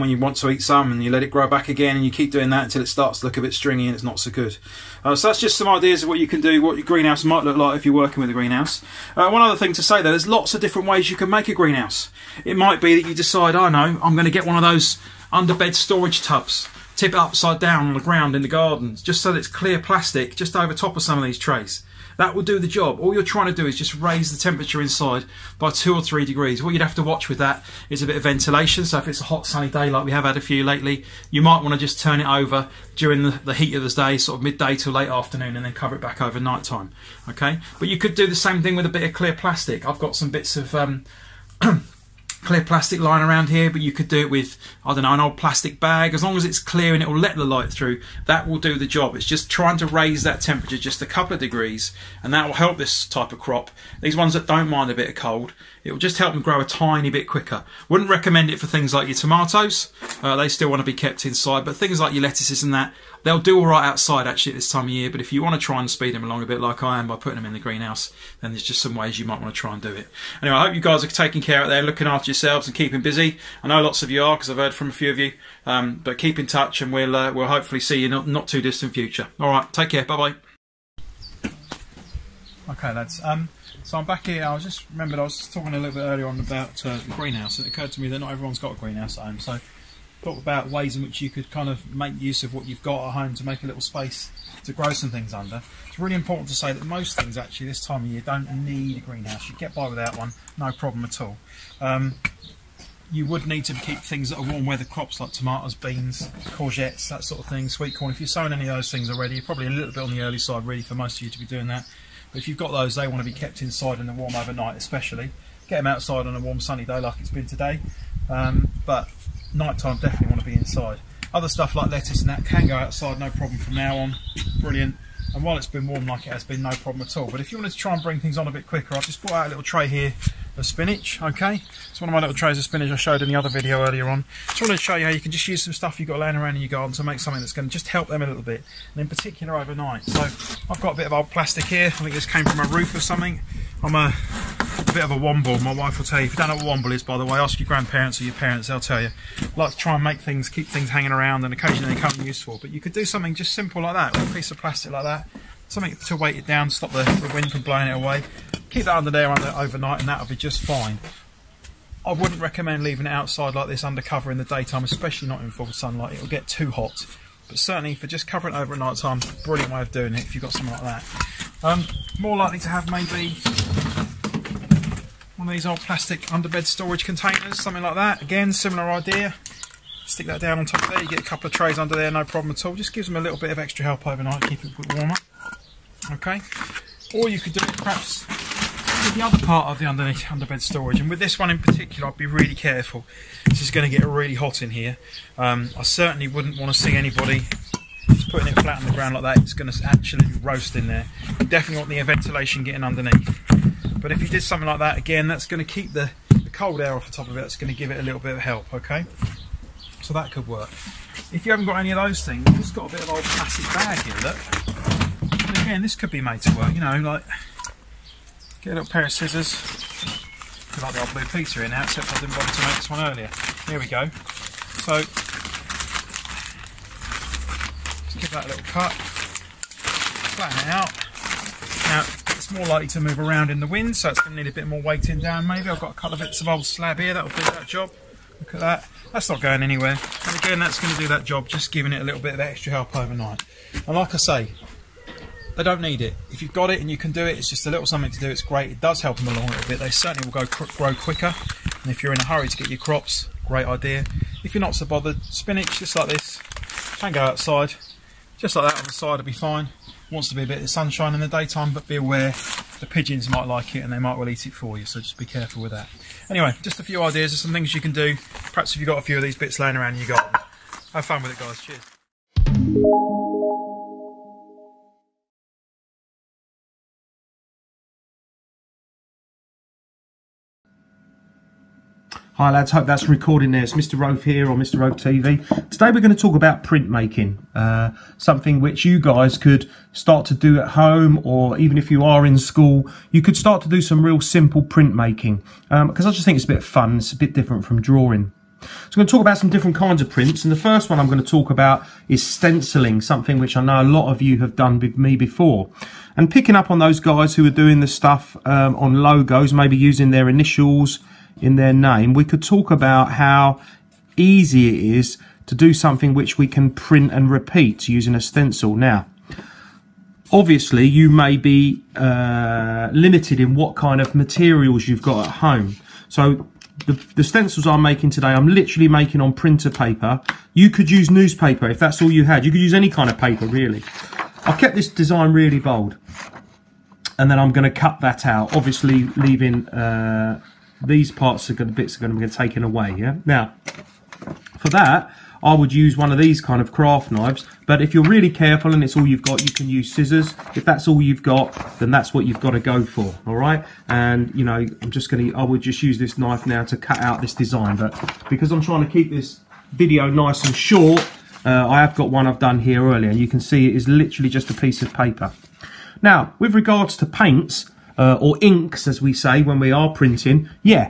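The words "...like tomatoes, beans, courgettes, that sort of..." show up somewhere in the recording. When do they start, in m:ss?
1:45.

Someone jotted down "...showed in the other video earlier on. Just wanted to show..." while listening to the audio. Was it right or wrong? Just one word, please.
right.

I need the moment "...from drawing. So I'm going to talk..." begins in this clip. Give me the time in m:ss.
4:57.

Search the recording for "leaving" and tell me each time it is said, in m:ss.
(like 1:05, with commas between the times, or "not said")
2:42, 5:39.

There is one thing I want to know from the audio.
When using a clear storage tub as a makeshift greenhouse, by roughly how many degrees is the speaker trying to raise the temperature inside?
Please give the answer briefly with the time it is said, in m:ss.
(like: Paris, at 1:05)
2 or 3 degrees, at 0:25.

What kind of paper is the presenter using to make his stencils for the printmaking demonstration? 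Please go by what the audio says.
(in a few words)
Printer paper.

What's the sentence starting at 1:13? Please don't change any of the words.
I know lots of you are because I've heard from a few of you.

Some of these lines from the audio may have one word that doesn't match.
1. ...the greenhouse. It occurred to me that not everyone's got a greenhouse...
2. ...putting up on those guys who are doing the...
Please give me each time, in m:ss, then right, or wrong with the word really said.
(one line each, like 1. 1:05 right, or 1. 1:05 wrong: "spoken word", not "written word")
1. 1:26 right
2. 5:06 wrong: "picking", not "putting".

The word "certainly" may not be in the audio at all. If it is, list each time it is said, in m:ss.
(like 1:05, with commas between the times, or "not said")
2:47, 3:15, 4:09.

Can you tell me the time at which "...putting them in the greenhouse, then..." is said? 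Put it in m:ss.
1:07.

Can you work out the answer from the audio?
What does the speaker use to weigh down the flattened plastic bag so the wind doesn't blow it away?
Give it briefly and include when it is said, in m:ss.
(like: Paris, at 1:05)
Old slab, at 3:56.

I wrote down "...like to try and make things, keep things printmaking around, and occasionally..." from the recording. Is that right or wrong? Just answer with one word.
wrong.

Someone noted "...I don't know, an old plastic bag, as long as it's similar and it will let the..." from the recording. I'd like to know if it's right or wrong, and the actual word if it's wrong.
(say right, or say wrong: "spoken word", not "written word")
wrong: "clear", not "similar".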